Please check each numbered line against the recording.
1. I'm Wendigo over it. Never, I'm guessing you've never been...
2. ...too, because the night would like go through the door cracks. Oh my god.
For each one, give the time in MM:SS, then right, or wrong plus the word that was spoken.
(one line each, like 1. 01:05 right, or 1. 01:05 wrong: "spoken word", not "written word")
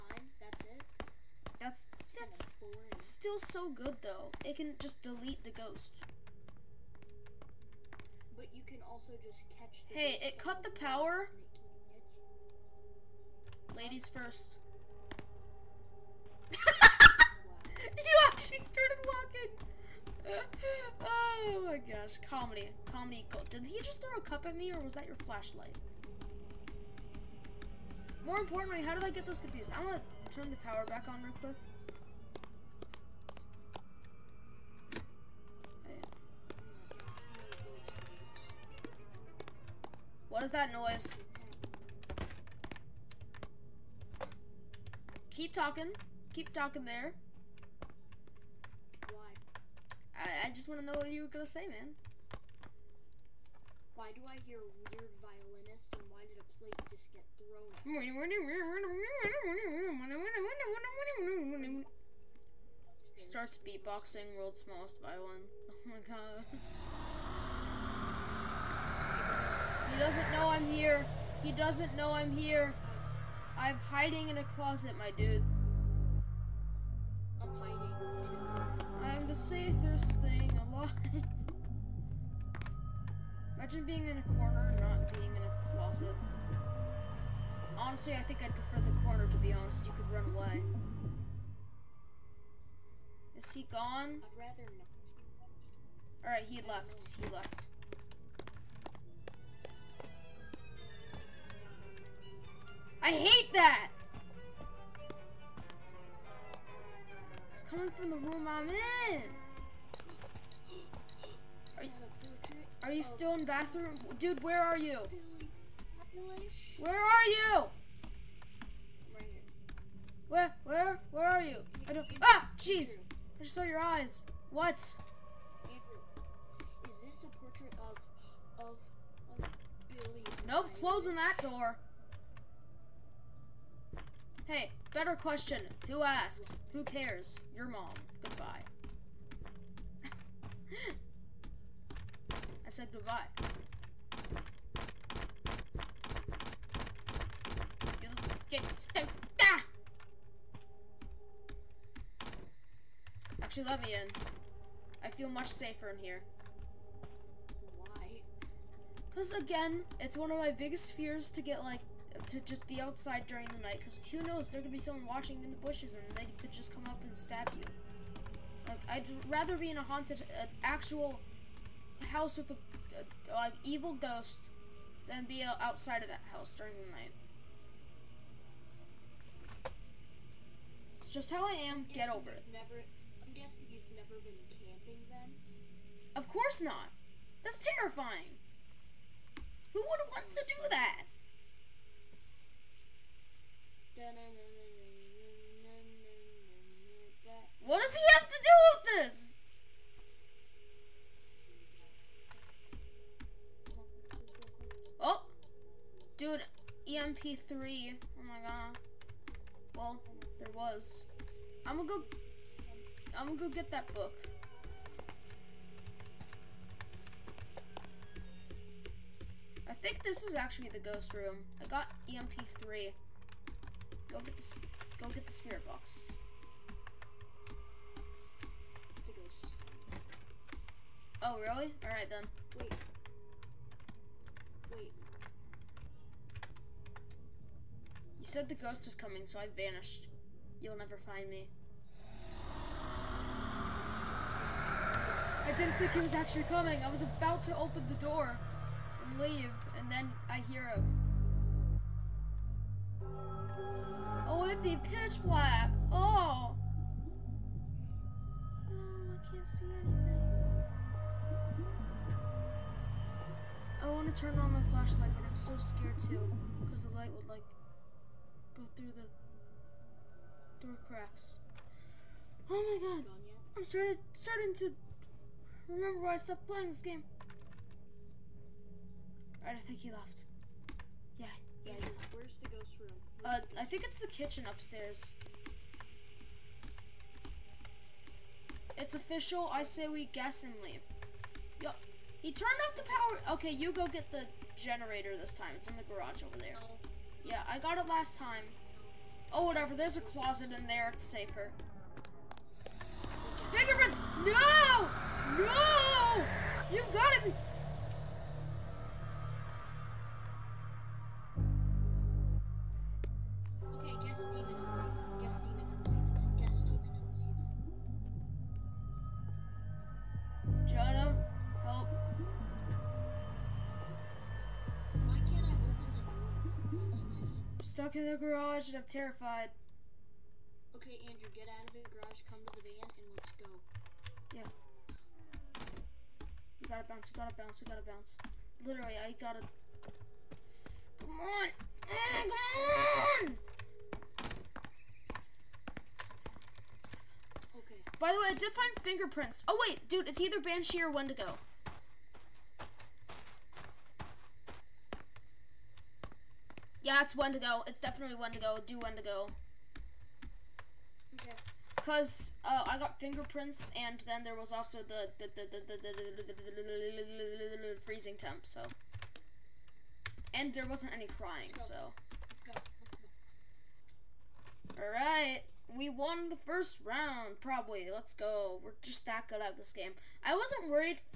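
1. 03:01 wrong: "Get", not "Wendigo"
2. 04:25 wrong: "light", not "night".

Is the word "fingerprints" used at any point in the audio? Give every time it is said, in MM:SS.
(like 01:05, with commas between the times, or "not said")
05:03, 05:48, 06:02.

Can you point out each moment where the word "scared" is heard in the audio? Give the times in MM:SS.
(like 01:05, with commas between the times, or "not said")
04:25.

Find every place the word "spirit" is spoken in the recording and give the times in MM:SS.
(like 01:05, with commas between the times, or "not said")
03:45.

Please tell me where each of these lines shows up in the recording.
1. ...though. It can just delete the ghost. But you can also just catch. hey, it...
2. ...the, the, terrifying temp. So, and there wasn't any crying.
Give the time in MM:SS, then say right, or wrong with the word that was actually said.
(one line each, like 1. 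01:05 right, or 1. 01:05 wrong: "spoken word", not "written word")
1. 00:04 right
2. 06:05 wrong: "freezing", not "terrifying".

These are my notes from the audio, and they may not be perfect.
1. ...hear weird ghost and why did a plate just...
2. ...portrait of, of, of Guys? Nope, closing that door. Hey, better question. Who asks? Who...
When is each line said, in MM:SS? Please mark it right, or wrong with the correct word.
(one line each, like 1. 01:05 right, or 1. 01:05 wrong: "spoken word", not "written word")
1. 00:54 wrong: "violinist", not "ghost"
2. 02:07 wrong: "Billy", not "Guys".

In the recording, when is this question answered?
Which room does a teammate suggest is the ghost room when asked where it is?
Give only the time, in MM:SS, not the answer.
04:43.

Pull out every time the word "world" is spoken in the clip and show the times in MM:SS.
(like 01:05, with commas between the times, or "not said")
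01:04.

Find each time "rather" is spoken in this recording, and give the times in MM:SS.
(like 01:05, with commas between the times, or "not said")
01:34, 02:49.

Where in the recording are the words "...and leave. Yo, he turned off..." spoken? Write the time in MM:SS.
04:50.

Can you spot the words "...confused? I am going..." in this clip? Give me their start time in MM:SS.
00:29.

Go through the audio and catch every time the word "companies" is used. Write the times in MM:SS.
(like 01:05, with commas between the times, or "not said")
not said.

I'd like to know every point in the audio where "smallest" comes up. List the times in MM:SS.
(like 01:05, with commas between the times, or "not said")
01:04.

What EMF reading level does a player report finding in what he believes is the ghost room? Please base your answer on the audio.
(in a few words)
3.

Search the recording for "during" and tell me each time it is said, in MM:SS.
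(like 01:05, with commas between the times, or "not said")
02:43, 02:56.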